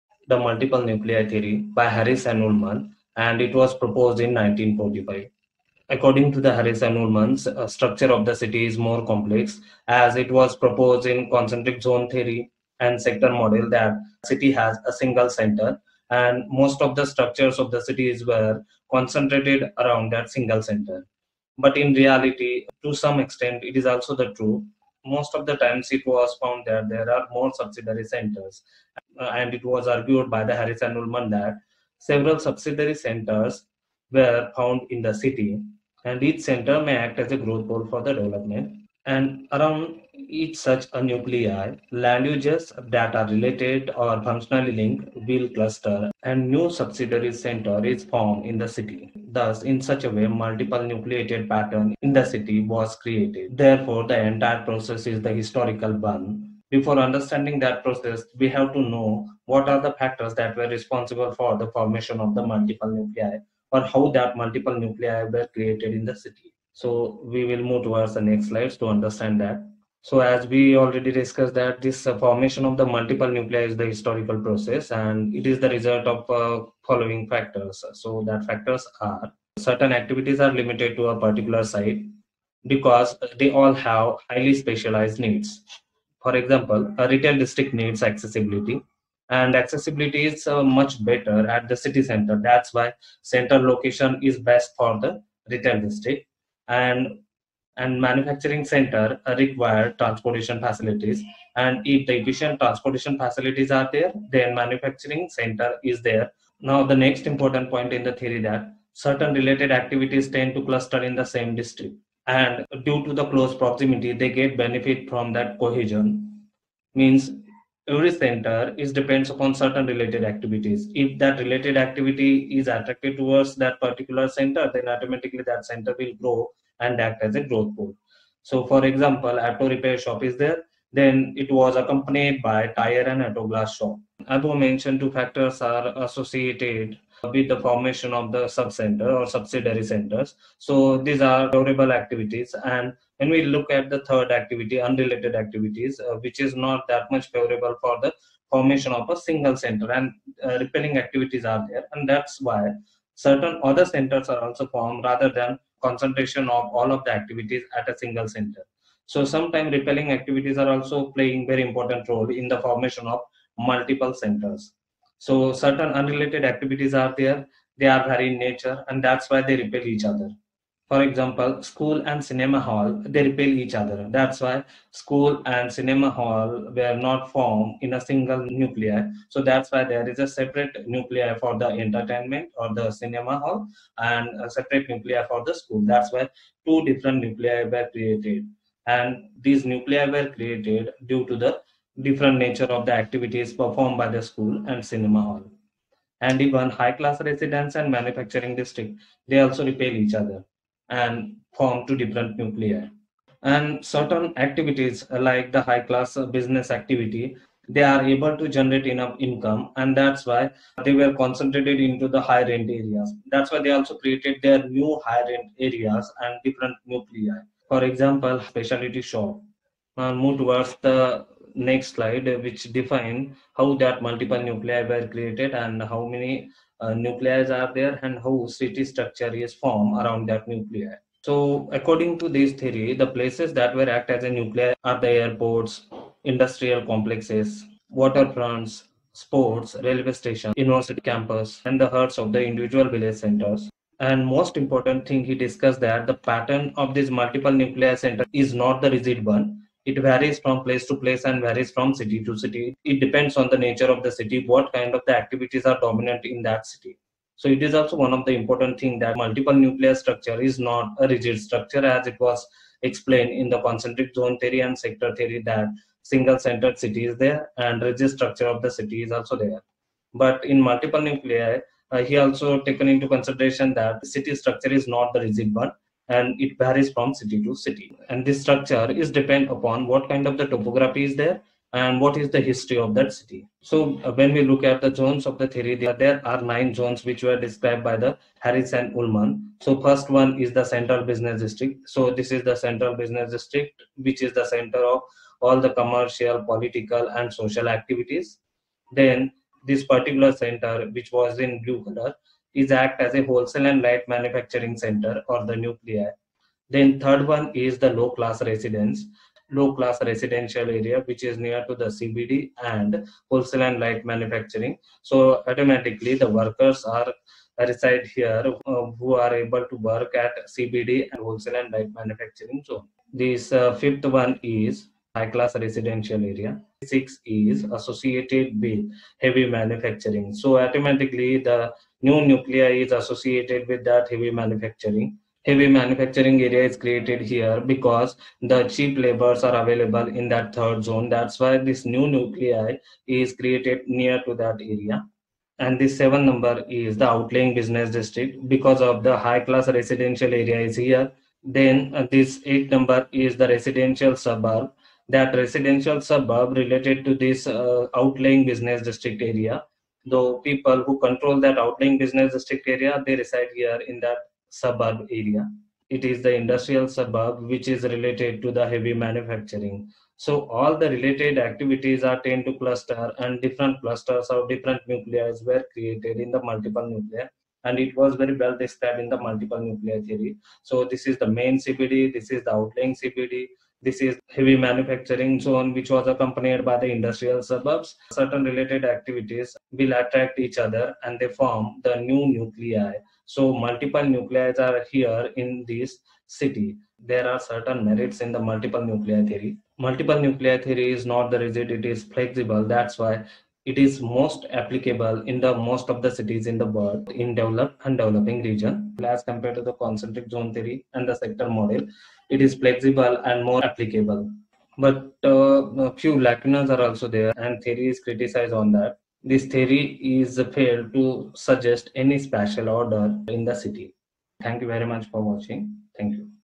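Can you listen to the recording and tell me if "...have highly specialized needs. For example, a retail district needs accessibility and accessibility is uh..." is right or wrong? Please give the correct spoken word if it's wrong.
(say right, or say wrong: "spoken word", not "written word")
right.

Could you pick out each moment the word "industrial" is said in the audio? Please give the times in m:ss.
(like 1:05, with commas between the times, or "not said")
3:56, 6:06, 6:26.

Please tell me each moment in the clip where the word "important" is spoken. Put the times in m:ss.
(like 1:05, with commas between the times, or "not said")
1:47, 2:41, 4:04, 4:18.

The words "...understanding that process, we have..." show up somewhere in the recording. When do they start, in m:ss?
0:56.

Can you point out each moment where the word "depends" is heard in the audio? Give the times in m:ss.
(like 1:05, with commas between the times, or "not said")
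1:58, 4:12, 4:39.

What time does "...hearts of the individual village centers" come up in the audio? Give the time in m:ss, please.
4:01.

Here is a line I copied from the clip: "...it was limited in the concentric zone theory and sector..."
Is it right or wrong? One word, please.
wrong.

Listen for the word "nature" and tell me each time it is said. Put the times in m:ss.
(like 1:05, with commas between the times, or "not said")
2:48, 3:12, 4:13.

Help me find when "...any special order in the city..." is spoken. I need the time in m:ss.
7:01.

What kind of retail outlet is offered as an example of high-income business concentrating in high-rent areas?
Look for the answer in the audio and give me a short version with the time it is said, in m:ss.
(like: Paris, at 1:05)
Specialty shop, at 3:38.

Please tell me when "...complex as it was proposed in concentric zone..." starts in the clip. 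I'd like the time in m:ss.
0:09.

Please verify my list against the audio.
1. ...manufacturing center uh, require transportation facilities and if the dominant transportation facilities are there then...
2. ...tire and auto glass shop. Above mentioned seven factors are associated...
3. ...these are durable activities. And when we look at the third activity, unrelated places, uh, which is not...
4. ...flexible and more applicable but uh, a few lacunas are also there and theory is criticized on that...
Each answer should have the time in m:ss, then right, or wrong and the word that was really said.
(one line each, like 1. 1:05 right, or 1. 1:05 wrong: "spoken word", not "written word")
1. 1:38 wrong: "efficient", not "dominant"
2. 2:12 wrong: "two", not "seven"
3. 2:20 wrong: "activities", not "places"
4. 6:52 right.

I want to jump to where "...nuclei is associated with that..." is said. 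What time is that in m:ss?
5:32.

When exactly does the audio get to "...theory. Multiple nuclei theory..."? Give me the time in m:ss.
6:39.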